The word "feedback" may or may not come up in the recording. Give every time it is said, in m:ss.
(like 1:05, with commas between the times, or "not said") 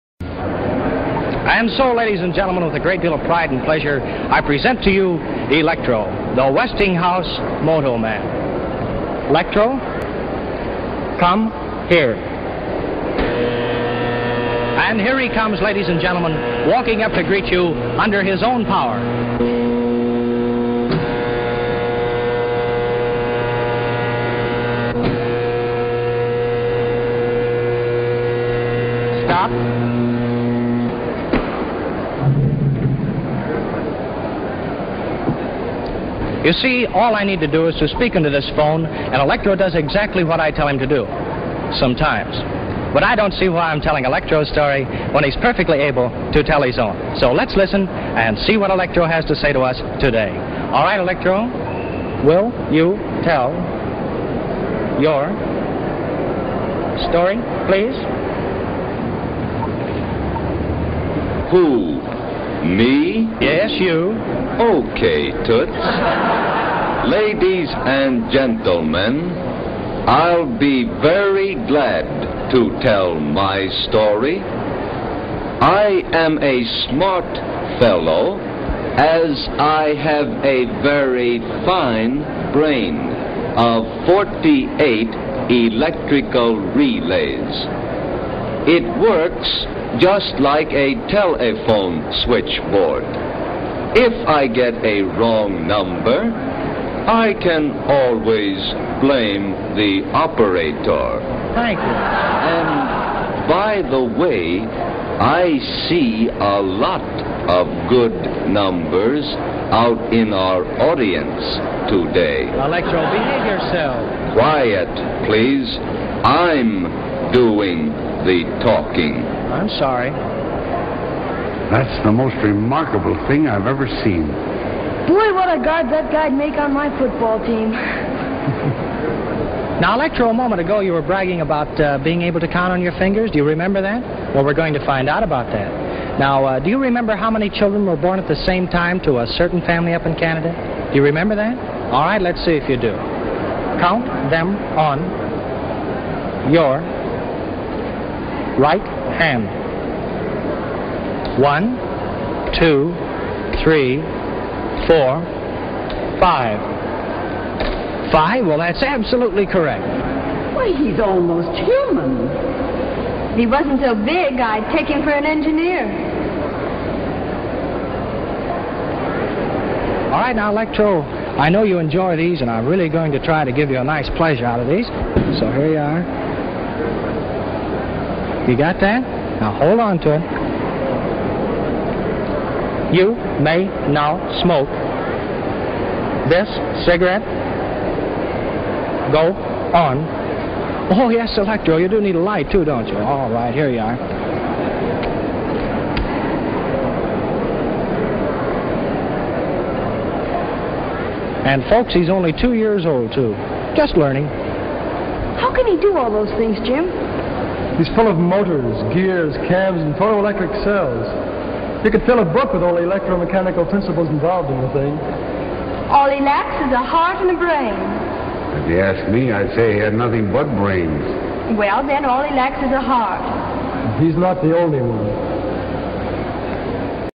not said.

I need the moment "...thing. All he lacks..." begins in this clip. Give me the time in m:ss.
3:34.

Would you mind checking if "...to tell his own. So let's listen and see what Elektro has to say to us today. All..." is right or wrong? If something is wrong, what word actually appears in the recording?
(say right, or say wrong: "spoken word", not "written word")
right.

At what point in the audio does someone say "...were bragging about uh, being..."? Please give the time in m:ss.
2:10.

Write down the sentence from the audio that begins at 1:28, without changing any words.
It works just like a telephone switchboard.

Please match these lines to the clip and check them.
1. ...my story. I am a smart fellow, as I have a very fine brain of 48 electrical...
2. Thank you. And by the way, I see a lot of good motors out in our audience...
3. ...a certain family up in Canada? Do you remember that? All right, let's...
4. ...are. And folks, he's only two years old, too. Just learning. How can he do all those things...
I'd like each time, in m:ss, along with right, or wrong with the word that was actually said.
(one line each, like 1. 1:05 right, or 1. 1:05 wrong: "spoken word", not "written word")
1. 1:13 right
2. 1:41 wrong: "numbers", not "motors"
3. 2:19 right
4. 3:13 right.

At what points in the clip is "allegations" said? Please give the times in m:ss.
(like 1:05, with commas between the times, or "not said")
not said.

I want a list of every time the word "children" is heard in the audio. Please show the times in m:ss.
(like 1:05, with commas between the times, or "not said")
2:17.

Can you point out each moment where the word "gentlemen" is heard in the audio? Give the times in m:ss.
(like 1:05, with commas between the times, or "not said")
0:02, 0:15, 1:08.